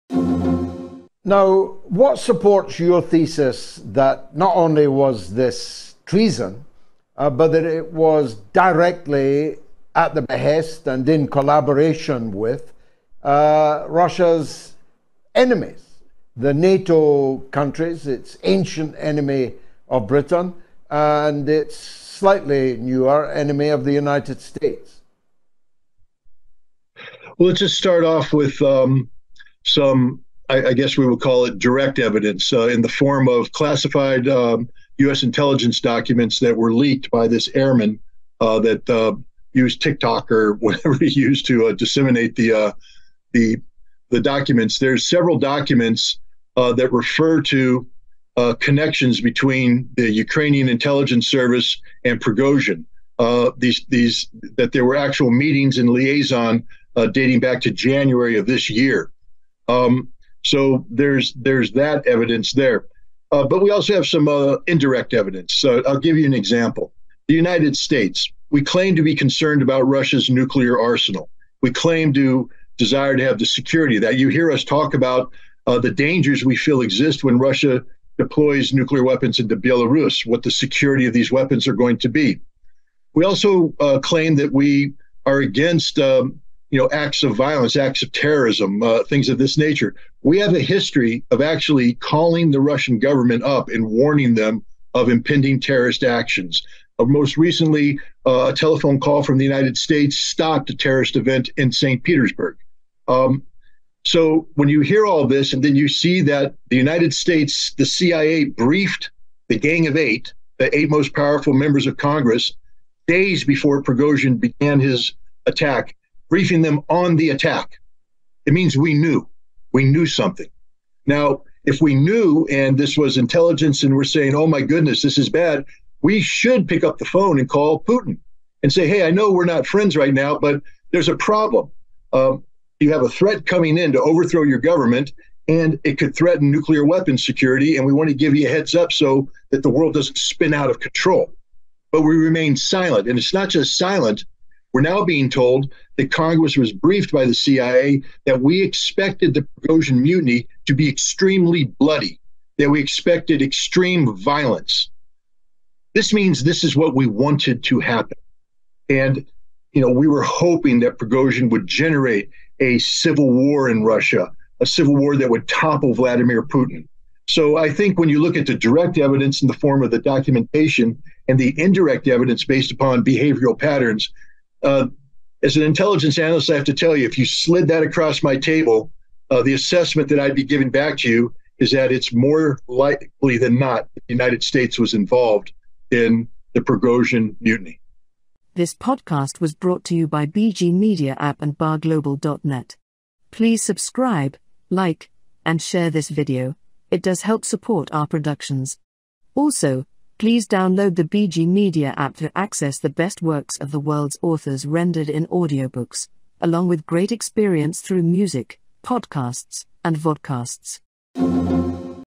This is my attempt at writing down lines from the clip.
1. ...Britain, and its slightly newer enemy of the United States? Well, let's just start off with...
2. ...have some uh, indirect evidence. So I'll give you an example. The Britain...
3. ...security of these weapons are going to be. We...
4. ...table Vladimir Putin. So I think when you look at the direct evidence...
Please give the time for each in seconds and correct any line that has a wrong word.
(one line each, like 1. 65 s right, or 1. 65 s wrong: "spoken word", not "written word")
1. 20 s right
2. 63 s wrong: "United", not "Britain"
3. 80 s right
4. 165 s wrong: "topple", not "table".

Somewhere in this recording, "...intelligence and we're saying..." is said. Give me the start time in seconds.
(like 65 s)
123 s.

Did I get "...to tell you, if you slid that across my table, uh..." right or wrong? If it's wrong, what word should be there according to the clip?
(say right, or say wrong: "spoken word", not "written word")
right.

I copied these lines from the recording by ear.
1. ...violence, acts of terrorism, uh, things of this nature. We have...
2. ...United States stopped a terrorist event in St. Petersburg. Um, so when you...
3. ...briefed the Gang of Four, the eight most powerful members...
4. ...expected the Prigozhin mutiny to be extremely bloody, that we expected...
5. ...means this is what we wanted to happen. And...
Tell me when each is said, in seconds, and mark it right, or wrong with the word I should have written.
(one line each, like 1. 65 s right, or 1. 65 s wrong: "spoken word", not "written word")
1. 87 s right
2. 99 s right
3. 108 s wrong: "Eight", not "Four"
4. 148 s right
5. 156 s right.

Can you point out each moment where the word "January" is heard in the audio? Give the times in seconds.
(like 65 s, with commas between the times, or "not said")
57 s.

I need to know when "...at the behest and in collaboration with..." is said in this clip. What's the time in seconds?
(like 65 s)
9 s.